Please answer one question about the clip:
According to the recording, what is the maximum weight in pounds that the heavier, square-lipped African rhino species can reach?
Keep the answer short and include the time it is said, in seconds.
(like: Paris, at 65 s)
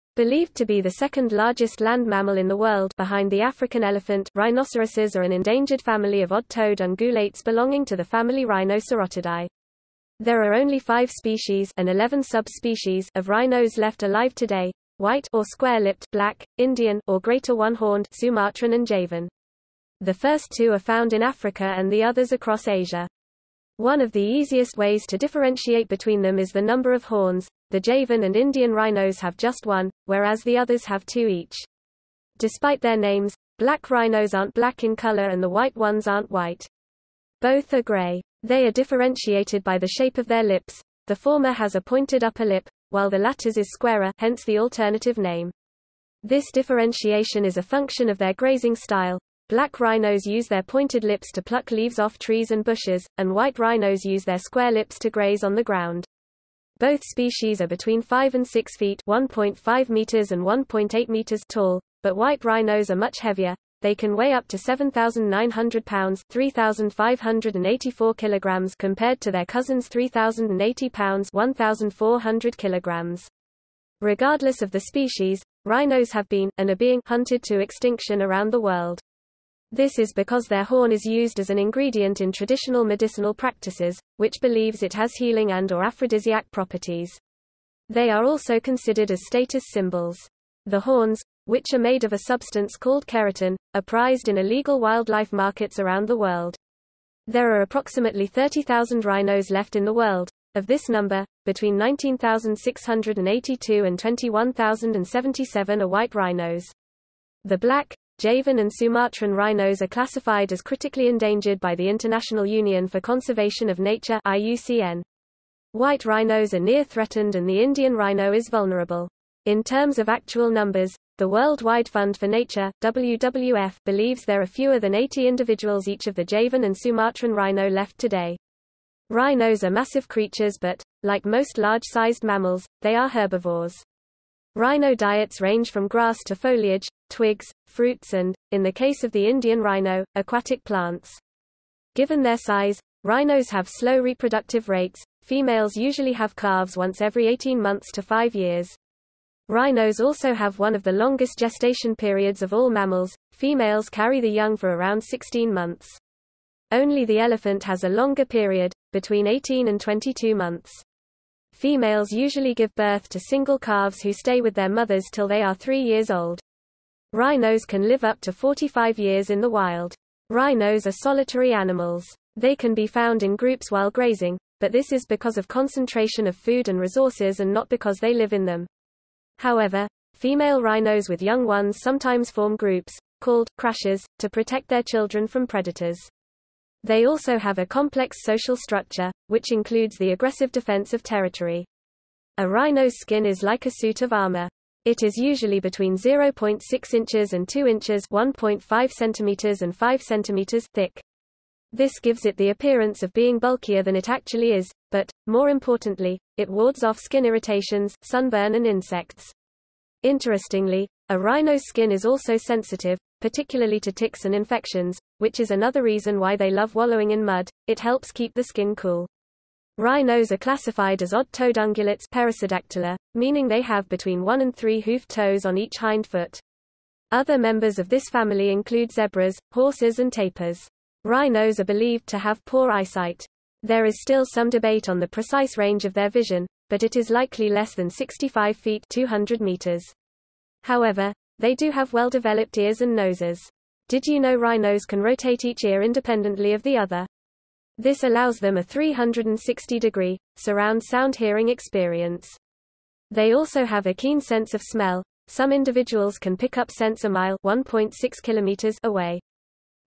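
7,900 pounds, at 64 s.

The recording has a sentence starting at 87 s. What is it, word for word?
They are also considered as status symbols.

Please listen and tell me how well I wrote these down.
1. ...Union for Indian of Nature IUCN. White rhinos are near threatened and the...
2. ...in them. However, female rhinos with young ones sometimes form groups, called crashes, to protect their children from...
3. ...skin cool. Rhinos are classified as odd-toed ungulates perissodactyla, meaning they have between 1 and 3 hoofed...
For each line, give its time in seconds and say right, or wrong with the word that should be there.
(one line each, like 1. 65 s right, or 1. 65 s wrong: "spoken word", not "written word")
1. 112 s wrong: "Conservation", not "Indian"
2. 178 s right
3. 218 s right.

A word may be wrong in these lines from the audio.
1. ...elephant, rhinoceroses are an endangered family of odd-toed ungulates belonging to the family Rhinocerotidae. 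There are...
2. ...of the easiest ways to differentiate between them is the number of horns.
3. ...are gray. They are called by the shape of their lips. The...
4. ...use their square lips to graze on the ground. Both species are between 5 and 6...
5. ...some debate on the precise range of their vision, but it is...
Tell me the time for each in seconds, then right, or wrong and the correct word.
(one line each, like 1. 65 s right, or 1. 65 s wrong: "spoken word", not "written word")
1. 3 s right
2. 24 s right
3. 37 s wrong: "differentiated", not "called"
4. 54 s right
5. 234 s right.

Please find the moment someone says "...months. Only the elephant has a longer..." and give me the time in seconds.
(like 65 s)
155 s.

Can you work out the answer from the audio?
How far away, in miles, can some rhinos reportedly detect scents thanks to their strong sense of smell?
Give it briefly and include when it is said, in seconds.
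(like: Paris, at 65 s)
1 mile, at 257 s.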